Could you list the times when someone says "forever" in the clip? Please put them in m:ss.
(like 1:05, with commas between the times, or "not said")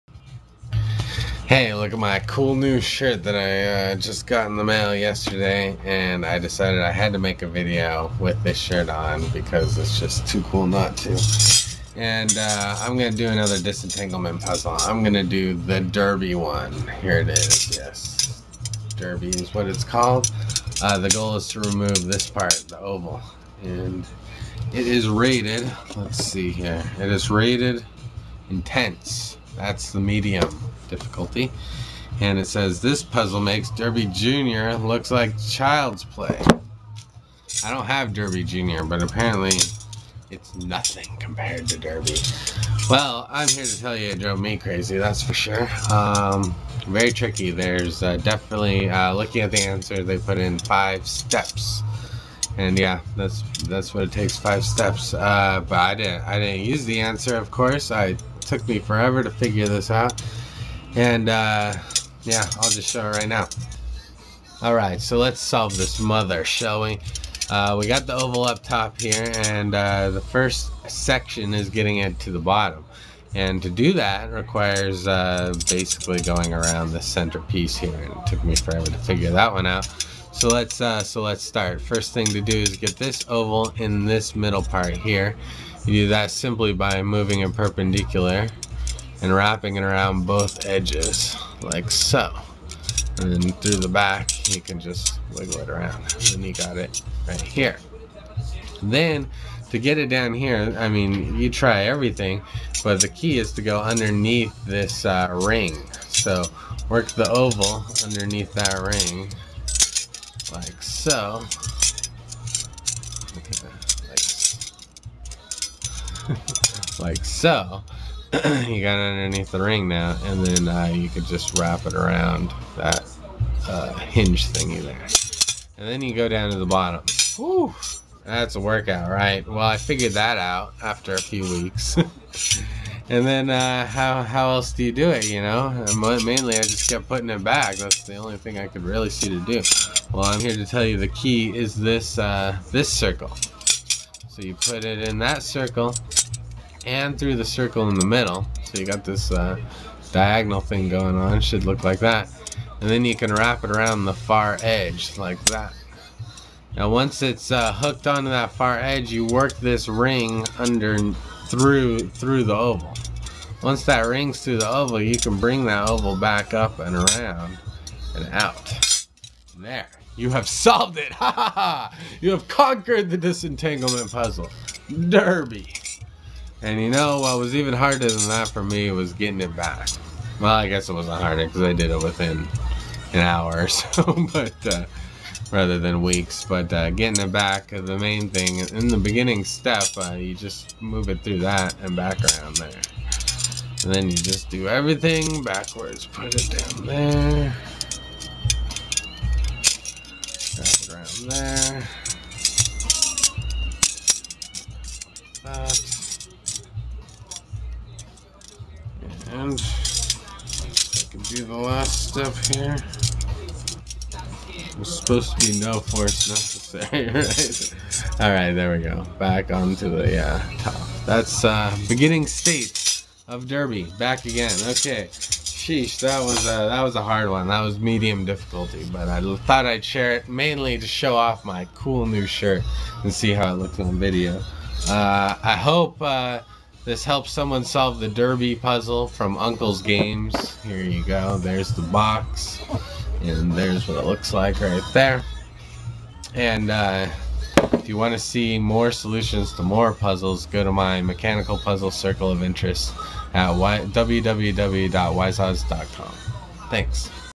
0:58, 1:18.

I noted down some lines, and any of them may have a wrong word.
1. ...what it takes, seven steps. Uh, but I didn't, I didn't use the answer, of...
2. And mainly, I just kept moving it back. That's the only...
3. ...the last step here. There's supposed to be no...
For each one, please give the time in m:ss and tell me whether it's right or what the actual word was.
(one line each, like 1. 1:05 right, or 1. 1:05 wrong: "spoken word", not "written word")
1. 0:53 wrong: "five", not "seven"
2. 2:15 wrong: "putting", not "moving"
3. 3:31 right.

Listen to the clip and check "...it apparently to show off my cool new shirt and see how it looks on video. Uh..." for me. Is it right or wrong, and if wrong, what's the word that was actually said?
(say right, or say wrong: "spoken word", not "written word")
wrong: "mainly", not "apparently".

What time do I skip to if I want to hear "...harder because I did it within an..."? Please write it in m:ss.
3:01.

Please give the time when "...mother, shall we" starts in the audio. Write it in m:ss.
1:06.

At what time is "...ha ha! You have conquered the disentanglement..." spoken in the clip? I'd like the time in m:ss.
2:51.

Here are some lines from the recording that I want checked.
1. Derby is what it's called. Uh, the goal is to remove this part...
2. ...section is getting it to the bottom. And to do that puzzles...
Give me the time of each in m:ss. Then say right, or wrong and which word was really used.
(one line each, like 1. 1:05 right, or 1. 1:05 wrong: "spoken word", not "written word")
1. 0:18 right
2. 1:10 wrong: "requires", not "puzzles".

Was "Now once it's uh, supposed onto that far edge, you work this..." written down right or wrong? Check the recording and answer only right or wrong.
wrong.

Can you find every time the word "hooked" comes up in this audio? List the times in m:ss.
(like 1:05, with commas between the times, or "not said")
2:37.